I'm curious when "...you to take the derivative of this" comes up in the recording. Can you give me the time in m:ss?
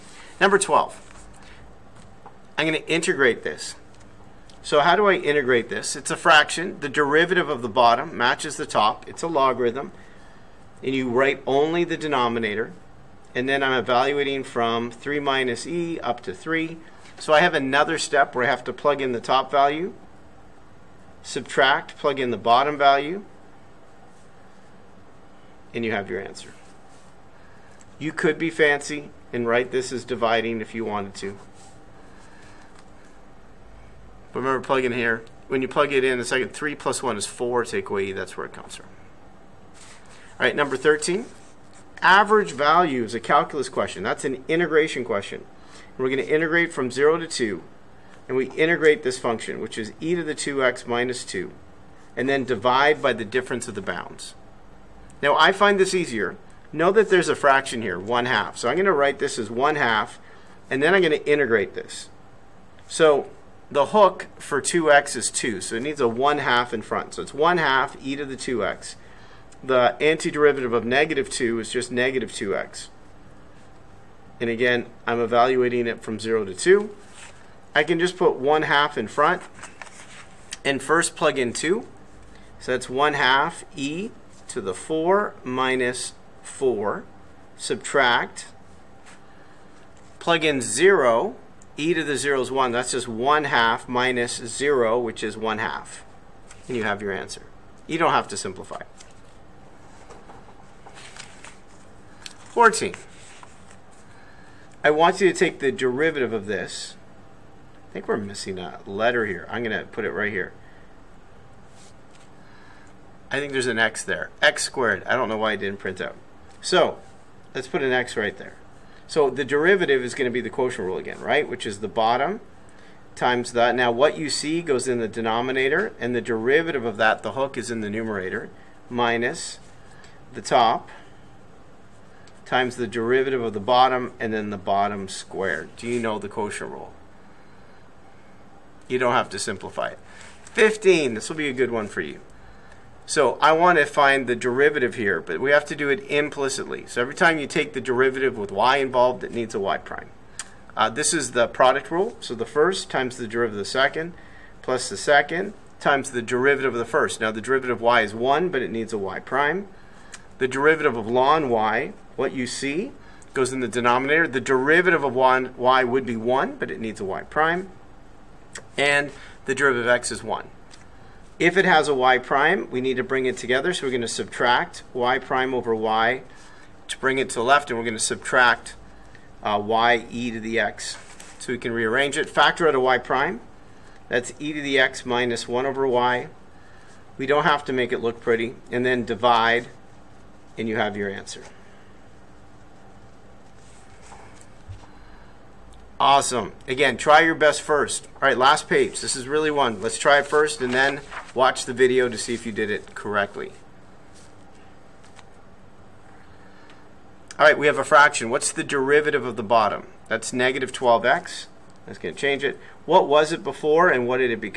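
1:45.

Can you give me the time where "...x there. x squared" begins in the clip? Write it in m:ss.
1:53.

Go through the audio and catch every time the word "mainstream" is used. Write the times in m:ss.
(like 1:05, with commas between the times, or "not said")
not said.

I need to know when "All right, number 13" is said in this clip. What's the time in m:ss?
0:40.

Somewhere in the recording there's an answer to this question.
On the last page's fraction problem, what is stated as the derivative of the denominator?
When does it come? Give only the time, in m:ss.
3:30.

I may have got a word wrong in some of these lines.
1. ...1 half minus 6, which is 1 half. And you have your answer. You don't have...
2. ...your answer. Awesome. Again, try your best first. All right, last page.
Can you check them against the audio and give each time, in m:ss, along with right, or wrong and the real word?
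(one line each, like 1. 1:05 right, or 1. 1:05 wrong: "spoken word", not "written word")
1. 1:33 wrong: "0", not "6"
2. 3:10 right.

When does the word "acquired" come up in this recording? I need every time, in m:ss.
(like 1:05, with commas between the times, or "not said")
not said.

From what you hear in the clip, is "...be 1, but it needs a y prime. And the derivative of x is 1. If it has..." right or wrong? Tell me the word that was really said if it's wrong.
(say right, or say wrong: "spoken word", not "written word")
right.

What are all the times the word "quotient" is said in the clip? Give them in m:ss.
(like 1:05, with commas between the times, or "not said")
2:00, 2:16.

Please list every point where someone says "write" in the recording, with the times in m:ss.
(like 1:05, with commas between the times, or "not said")
0:11, 0:29, 0:58.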